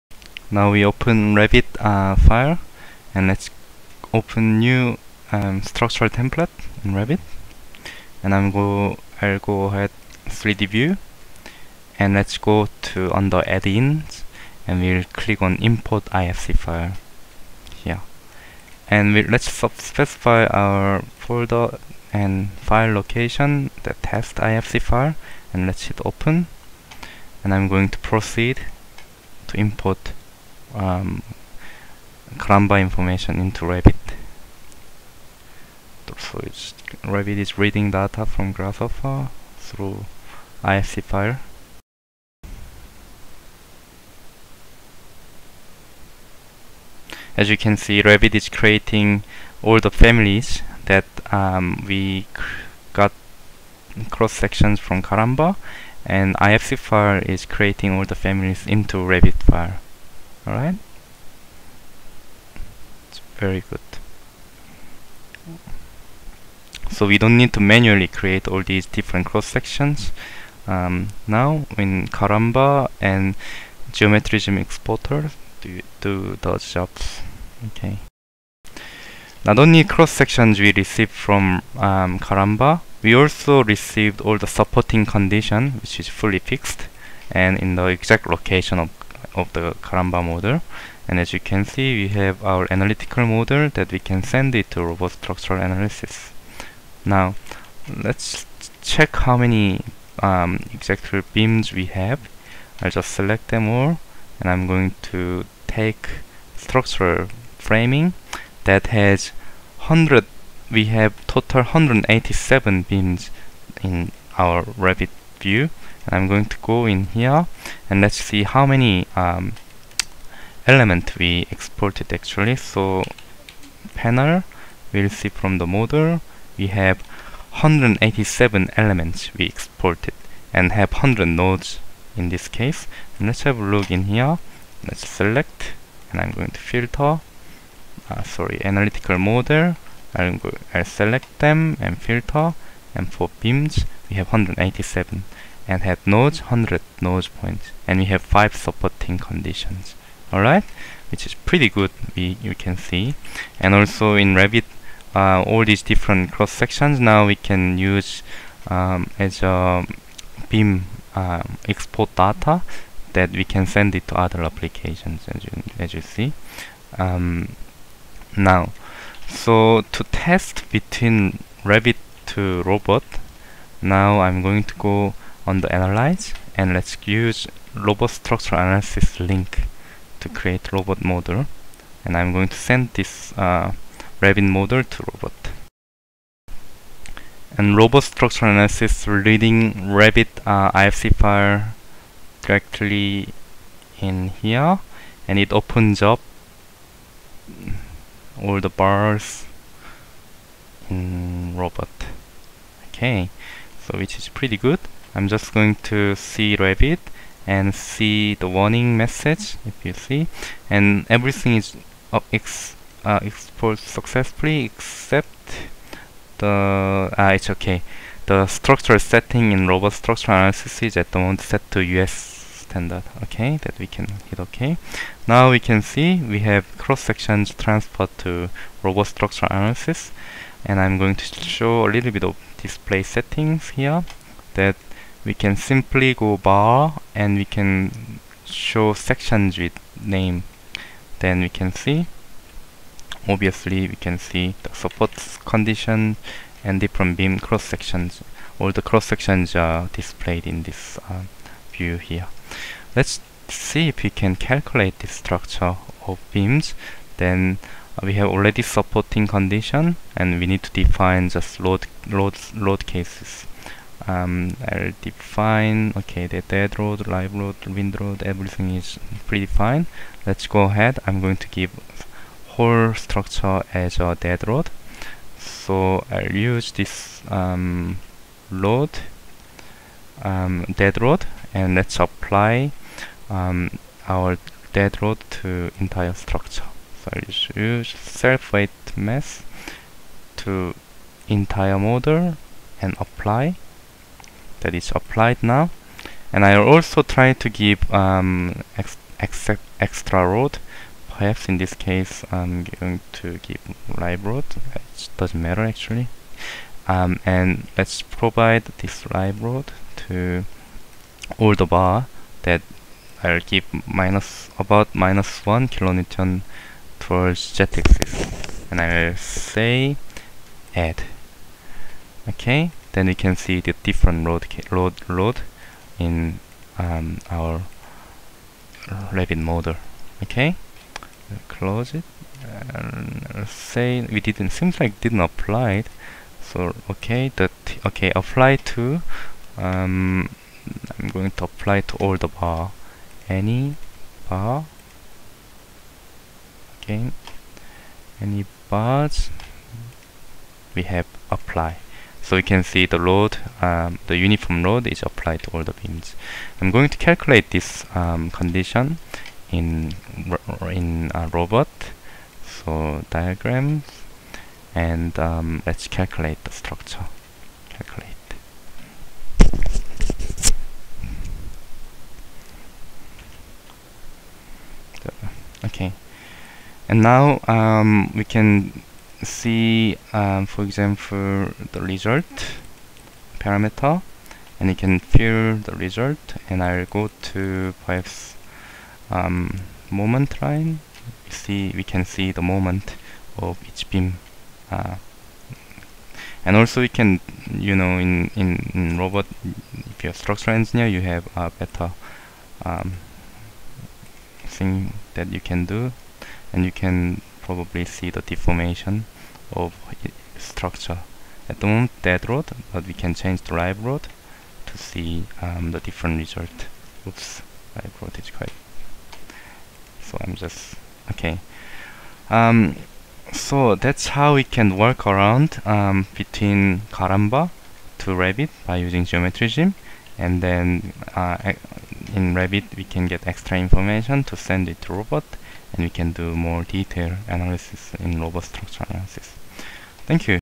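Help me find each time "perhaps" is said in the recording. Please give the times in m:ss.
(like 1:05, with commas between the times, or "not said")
5:01, 6:27.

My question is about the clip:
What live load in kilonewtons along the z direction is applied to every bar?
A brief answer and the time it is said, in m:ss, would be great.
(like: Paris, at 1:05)
-1 kN, at 5:14.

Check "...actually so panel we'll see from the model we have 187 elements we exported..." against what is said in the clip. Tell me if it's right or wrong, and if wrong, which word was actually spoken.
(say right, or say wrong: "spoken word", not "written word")
right.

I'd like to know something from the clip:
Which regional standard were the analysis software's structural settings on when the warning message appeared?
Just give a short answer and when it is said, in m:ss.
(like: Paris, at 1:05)
US standard, at 3:41.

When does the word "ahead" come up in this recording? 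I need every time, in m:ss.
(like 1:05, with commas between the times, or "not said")
0:09, 4:30.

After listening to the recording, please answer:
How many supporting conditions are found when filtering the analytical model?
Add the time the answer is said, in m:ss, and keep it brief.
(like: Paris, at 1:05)
5, at 2:28.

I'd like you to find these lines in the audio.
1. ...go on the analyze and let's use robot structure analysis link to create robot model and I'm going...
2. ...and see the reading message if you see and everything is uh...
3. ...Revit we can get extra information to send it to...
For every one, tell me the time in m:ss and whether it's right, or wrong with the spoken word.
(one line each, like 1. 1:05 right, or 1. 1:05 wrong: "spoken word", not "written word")
1. 2:54 right
2. 3:27 wrong: "warning", not "reading"
3. 7:12 right.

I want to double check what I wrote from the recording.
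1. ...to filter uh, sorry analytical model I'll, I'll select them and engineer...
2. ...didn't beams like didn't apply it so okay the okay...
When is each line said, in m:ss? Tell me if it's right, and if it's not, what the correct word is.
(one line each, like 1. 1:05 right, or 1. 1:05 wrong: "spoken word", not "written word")
1. 2:16 wrong: "filter", not "engineer"
2. 5:34 wrong: "seems", not "beams".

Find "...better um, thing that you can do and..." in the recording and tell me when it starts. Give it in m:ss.
6:41.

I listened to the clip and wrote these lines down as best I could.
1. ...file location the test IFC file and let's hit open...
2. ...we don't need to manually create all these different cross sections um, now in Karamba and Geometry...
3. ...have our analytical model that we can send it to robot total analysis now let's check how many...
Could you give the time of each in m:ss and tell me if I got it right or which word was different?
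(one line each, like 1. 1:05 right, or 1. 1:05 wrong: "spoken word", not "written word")
1. 0:22 right
2. 1:07 right
3. 1:32 wrong: "structural", not "total".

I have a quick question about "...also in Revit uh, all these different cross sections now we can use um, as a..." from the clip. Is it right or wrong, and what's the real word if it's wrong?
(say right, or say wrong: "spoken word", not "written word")
right.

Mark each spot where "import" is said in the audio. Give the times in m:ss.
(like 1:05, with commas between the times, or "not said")
0:15, 0:29.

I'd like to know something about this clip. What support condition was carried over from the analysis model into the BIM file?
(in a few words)
Fully fixed.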